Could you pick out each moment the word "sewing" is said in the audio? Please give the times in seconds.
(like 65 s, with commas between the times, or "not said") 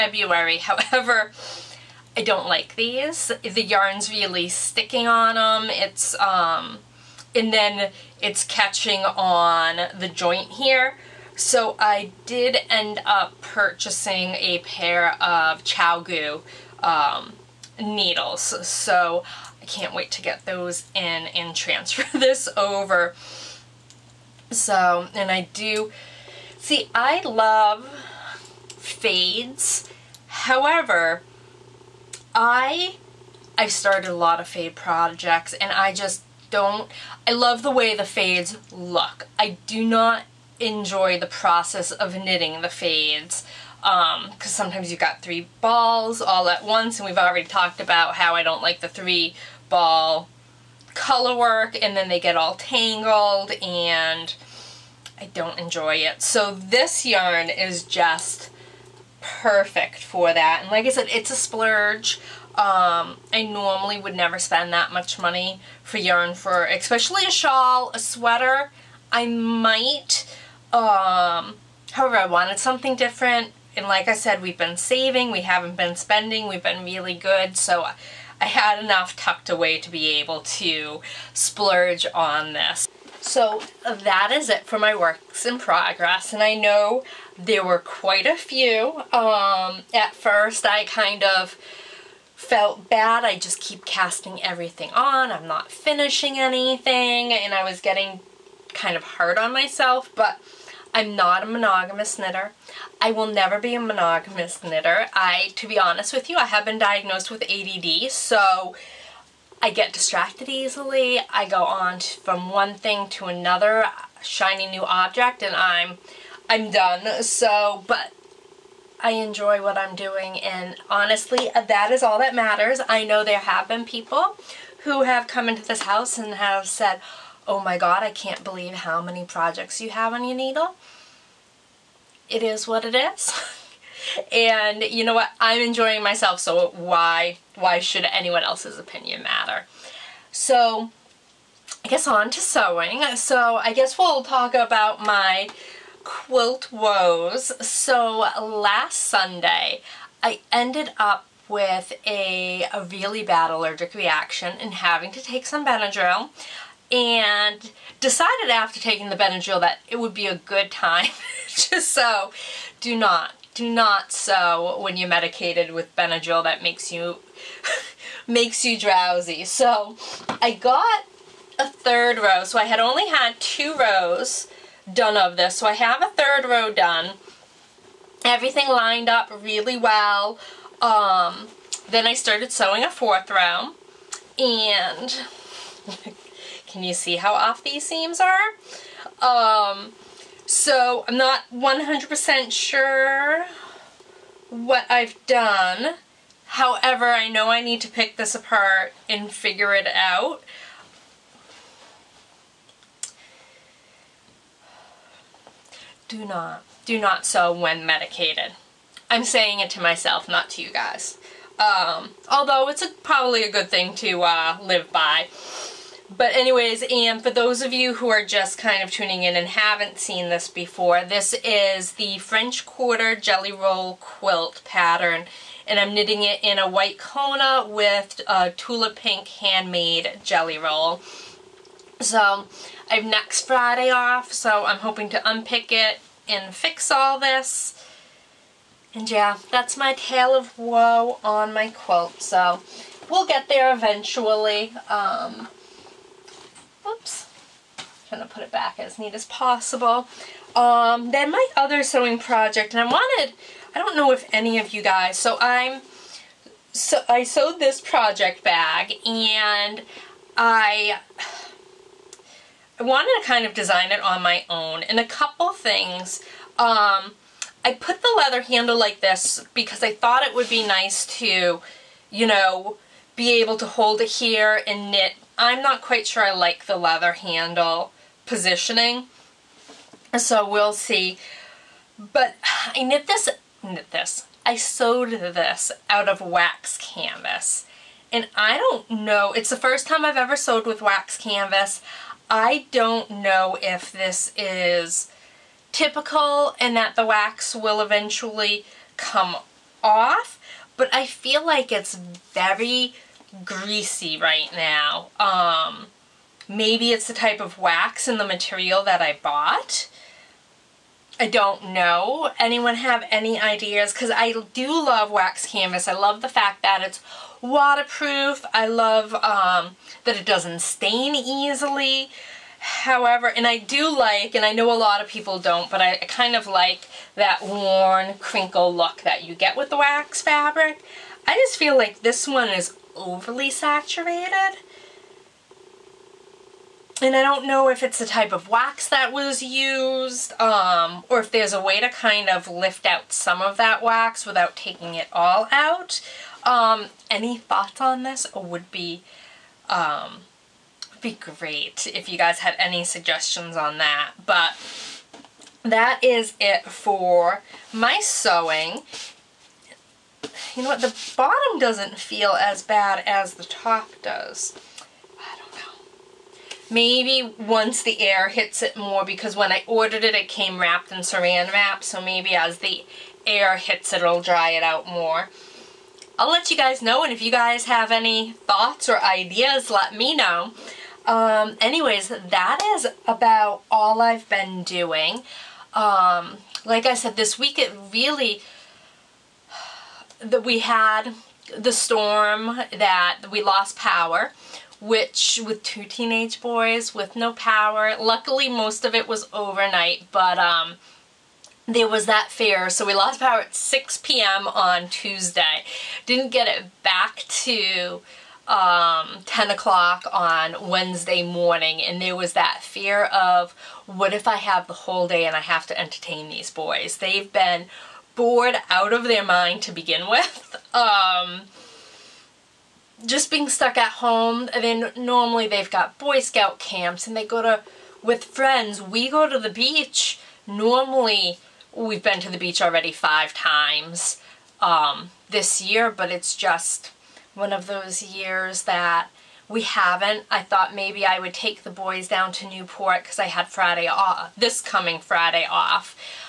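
142 s, 182 s, 251 s, 358 s.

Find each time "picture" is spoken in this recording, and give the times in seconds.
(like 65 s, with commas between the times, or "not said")
not said.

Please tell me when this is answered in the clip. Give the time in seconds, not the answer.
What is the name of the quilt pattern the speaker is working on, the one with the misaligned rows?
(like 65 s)
222 s.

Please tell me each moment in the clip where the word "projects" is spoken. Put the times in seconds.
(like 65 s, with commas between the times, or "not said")
34 s, 129 s, 252 s, 257 s.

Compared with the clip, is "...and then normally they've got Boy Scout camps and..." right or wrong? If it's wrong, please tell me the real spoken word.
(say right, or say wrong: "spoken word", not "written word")
right.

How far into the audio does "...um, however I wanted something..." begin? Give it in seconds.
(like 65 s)
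70 s.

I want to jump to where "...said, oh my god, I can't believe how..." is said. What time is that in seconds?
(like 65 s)
126 s.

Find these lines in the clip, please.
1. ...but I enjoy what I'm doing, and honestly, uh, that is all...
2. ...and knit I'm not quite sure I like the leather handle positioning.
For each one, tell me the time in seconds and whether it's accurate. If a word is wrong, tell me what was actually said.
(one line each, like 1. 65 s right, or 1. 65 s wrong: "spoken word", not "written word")
1. 117 s right
2. 274 s right.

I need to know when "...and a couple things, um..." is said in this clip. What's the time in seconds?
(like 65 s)
264 s.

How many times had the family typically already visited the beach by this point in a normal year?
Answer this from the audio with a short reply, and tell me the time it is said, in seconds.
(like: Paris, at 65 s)
5, at 432 s.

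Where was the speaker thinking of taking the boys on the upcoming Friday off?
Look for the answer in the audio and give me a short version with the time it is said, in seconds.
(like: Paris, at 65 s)
Newport, at 442 s.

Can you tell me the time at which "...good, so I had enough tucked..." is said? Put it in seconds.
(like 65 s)
77 s.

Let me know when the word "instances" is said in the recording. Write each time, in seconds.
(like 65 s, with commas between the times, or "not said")
not said.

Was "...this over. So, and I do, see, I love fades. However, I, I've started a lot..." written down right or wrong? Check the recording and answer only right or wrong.
right.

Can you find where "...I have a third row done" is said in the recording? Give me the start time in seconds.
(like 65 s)
175 s.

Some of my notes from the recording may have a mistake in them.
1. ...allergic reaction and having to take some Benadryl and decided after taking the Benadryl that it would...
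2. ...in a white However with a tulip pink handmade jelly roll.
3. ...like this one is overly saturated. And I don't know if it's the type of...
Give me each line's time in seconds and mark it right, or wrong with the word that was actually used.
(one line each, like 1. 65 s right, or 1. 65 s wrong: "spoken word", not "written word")
1. 153 s right
2. 226 s wrong: "Kona", not "However"
3. 331 s right.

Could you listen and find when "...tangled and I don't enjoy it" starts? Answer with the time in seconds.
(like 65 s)
52 s.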